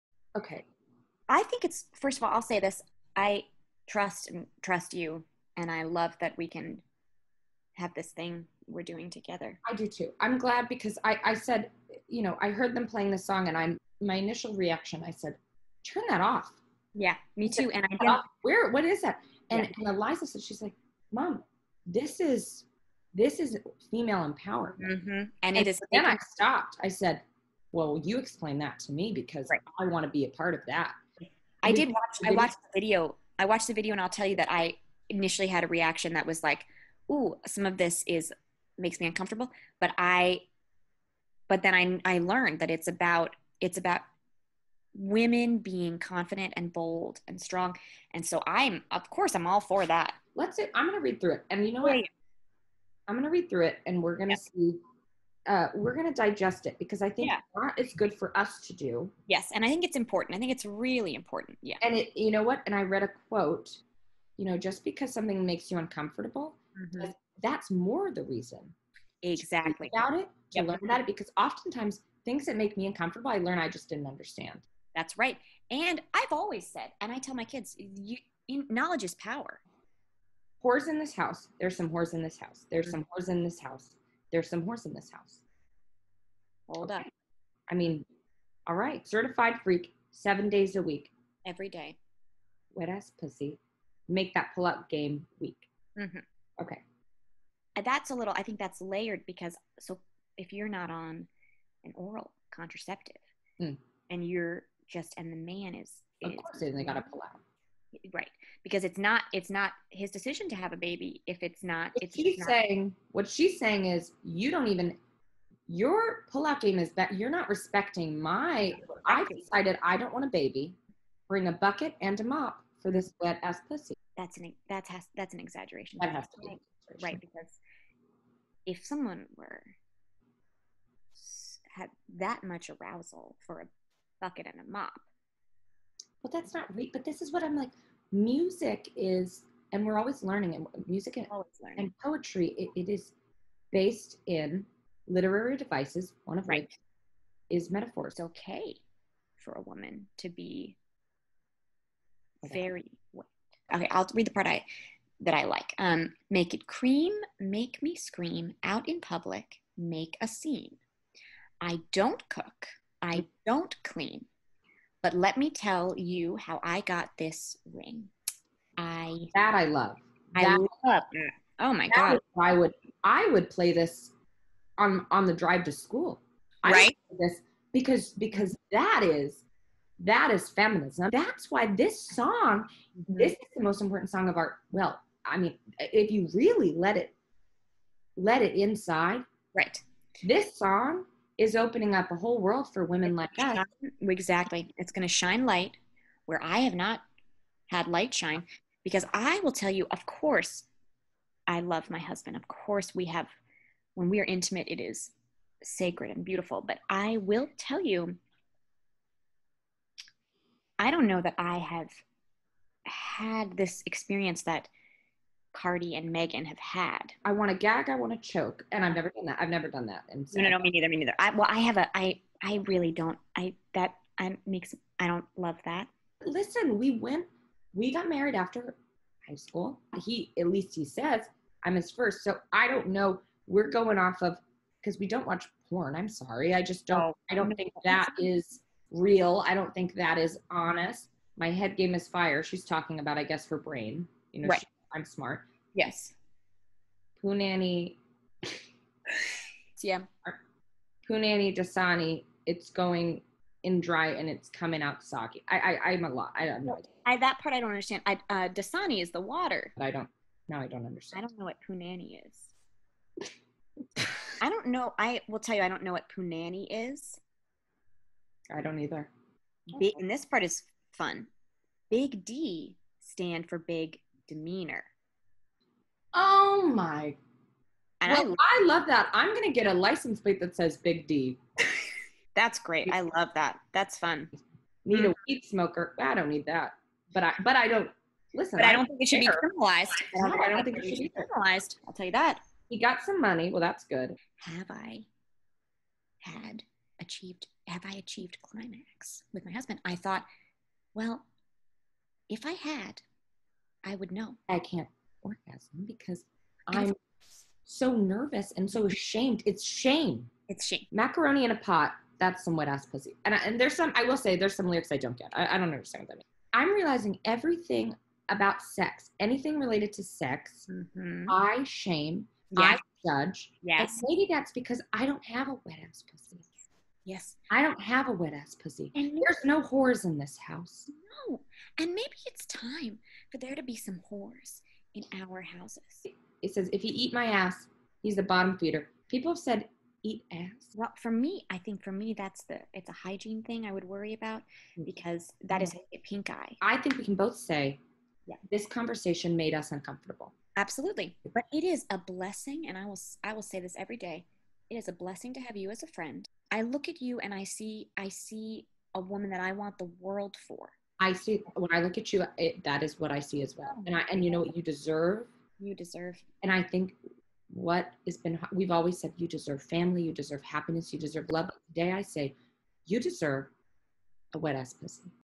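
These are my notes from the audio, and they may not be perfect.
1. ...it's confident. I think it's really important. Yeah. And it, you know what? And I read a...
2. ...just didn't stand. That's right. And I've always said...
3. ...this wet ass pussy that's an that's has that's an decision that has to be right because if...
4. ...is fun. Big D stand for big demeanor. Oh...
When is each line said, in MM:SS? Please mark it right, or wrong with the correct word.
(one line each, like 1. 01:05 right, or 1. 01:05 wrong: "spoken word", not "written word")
1. 00:59 wrong: "important", not "confident"
2. 01:13 wrong: "understand", not "stand"
3. 02:02 wrong: "exaggeration", not "decision"
4. 04:30 right.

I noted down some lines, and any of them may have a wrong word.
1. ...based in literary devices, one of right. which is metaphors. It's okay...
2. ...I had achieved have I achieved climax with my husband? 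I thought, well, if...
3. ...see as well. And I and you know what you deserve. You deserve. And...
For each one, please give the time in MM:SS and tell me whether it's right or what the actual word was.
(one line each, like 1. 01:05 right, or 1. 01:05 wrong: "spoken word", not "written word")
1. 02:23 right
2. 04:54 right
3. 06:03 right.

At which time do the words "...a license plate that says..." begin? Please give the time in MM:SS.
04:39.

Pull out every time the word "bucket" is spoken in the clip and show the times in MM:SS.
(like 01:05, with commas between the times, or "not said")
02:01, 02:14.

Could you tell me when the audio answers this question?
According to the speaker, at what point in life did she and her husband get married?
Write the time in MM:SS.
03:48.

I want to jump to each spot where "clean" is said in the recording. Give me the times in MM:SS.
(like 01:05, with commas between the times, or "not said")
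02:43.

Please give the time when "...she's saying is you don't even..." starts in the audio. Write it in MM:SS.
01:53.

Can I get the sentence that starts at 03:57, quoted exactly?
Oh, I don't think that is real.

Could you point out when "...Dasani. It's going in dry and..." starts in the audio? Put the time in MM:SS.
04:11.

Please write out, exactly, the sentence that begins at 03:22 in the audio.
Of course, we have, when we are intimate, it is sacred and beautiful.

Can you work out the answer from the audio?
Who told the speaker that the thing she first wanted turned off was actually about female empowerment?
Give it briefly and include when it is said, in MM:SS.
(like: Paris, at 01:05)
Eliza, at 00:19.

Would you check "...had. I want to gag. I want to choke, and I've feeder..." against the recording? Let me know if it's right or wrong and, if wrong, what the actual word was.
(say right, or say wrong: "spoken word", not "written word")
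wrong: "never", not "feeder".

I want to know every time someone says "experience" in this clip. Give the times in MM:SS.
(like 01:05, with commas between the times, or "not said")
03:33.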